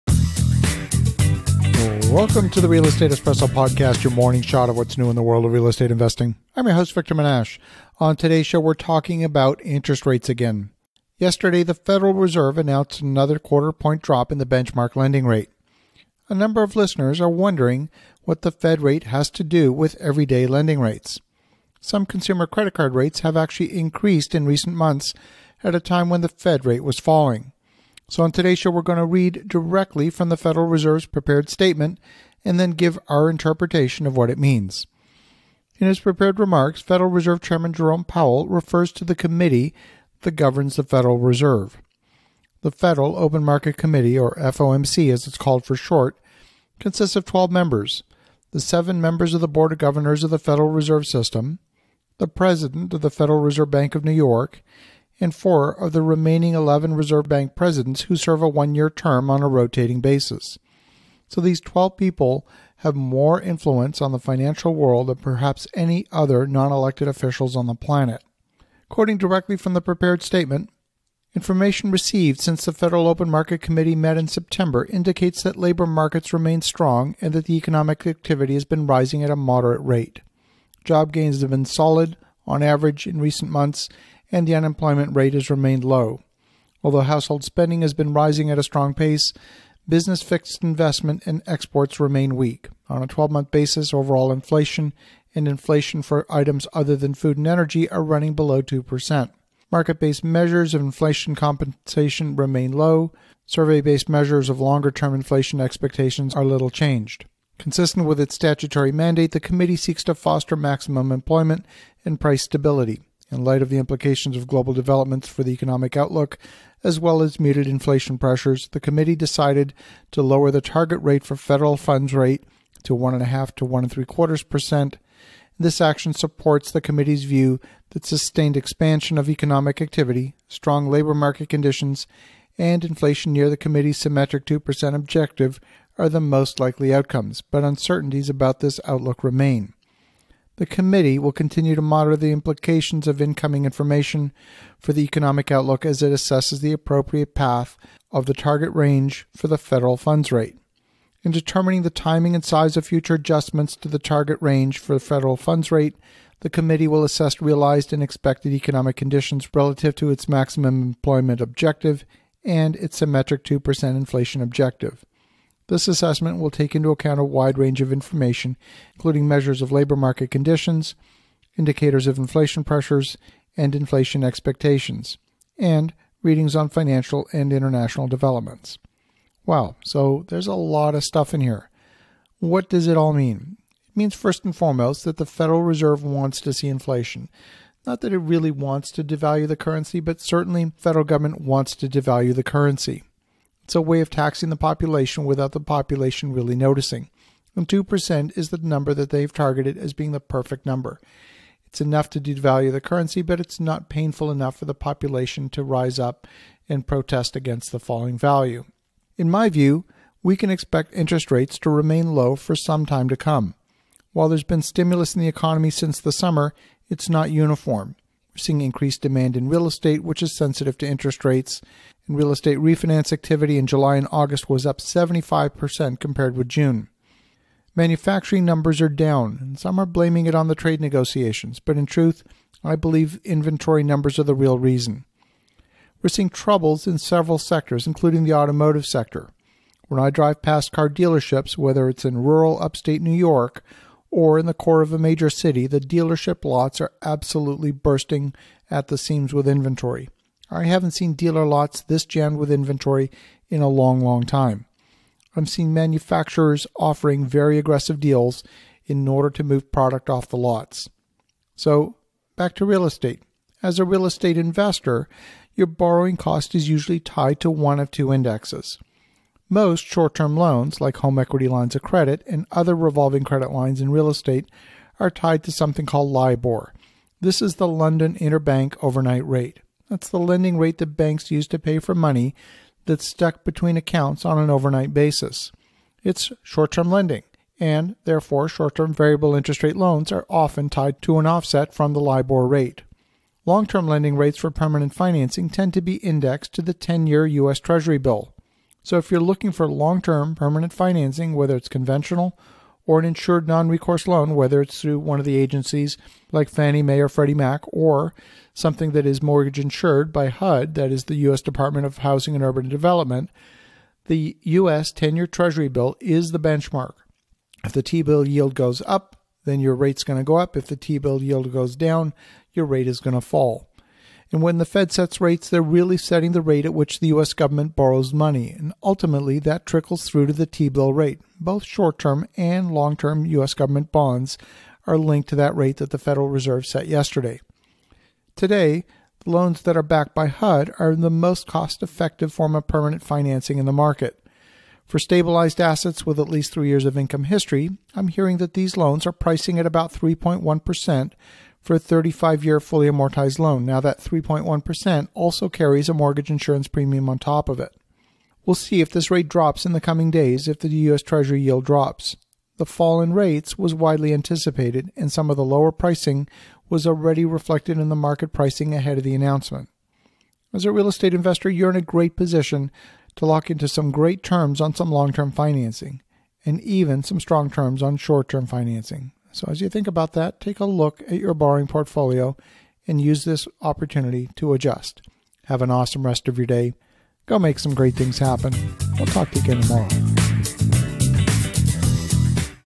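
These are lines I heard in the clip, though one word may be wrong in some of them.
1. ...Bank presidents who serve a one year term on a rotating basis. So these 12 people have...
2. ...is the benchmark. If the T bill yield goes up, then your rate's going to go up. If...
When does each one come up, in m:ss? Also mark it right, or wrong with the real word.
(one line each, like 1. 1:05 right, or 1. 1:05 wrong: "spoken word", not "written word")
1. 0:57 right
2. 5:15 right.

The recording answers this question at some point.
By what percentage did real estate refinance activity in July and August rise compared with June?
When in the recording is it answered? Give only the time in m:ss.
3:44.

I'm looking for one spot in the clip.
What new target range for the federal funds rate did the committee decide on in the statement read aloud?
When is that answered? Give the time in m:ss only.
2:02.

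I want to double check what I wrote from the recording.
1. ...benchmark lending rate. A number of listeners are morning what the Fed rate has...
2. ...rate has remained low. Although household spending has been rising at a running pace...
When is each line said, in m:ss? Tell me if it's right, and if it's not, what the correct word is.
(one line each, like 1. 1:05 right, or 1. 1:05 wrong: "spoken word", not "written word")
1. 0:14 wrong: "wondering", not "morning"
2. 1:25 wrong: "strong", not "running".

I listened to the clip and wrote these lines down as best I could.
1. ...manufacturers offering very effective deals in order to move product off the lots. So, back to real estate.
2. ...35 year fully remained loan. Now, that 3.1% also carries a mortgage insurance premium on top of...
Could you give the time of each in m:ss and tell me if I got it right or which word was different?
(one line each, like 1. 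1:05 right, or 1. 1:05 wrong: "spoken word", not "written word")
1. 4:15 wrong: "aggressive", not "effective"
2. 5:51 wrong: "amortized", not "remained".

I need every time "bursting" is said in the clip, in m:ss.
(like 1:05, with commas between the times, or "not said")
4:07.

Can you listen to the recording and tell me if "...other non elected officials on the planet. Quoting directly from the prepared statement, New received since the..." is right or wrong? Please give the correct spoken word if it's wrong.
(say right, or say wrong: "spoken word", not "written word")
wrong: "Information", not "New".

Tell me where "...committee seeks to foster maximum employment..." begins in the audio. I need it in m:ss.
1:49.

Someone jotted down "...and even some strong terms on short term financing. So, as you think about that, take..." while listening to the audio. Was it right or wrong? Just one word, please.
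right.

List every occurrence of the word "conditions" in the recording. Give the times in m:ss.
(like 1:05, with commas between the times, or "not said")
2:11, 2:38, 2:50.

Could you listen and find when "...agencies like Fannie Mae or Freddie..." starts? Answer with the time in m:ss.
5:05.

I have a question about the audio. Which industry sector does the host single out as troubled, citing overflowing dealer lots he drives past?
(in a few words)
Automotive sector.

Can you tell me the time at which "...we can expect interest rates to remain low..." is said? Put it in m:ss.
3:30.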